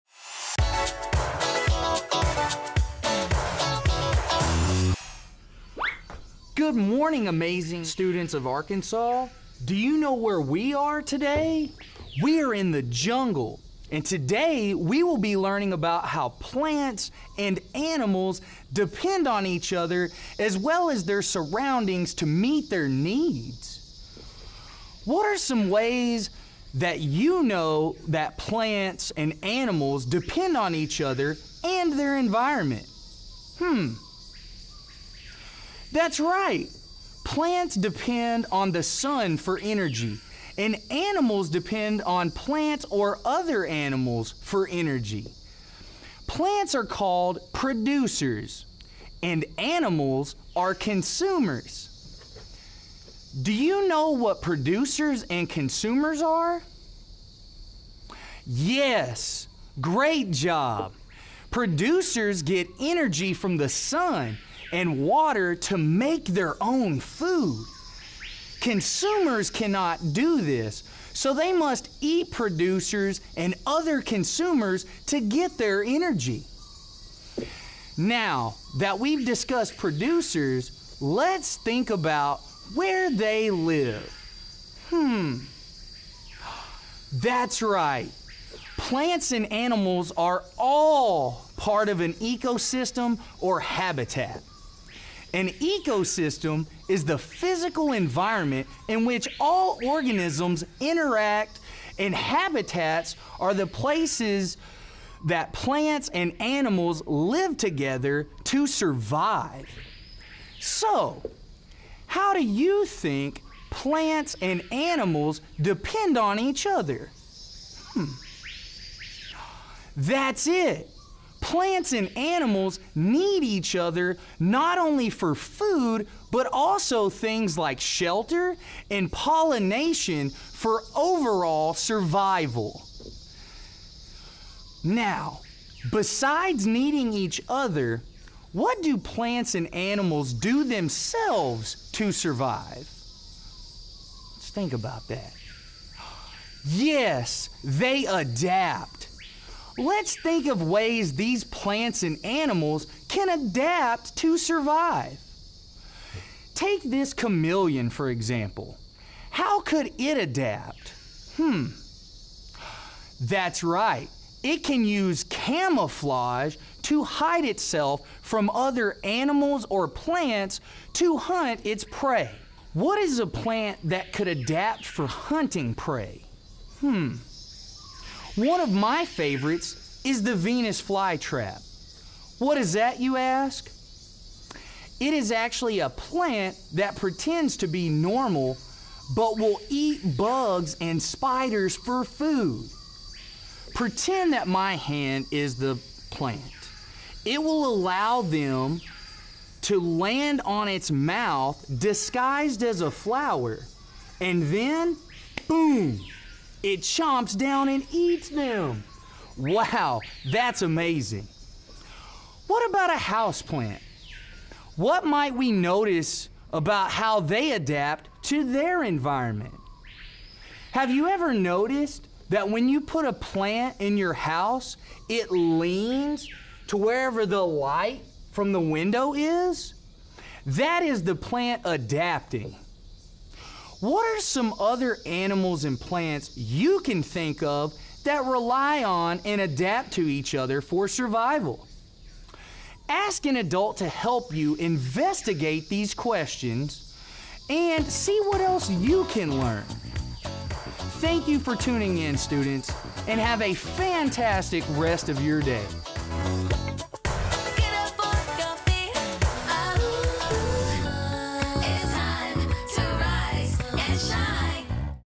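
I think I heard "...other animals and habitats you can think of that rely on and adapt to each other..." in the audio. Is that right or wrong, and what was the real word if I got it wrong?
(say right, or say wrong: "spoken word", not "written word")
wrong: "plants", not "habitats".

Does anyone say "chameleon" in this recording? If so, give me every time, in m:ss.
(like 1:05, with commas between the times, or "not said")
2:37.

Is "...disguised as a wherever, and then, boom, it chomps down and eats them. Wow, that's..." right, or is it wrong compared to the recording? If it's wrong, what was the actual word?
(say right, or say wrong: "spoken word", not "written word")
wrong: "flower", not "wherever".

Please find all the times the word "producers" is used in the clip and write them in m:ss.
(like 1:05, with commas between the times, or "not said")
0:47, 0:54, 1:01, 1:12, 1:19.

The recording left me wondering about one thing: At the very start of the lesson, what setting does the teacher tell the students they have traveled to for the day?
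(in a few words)
The jungle.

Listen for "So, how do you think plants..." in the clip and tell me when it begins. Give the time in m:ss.
1:50.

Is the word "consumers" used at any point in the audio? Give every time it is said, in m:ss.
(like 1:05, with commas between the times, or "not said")
0:50, 0:55, 1:08, 1:14.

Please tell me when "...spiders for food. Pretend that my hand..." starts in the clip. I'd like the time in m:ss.
3:11.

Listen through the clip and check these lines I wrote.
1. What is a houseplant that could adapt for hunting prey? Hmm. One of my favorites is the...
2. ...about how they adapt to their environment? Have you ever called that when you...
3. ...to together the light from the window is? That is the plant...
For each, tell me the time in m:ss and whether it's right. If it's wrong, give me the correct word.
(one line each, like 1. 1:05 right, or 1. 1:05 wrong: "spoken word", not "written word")
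1. 2:52 wrong: "plant", not "houseplant"
2. 3:36 wrong: "noticed", not "called"
3. 3:46 wrong: "wherever", not "together".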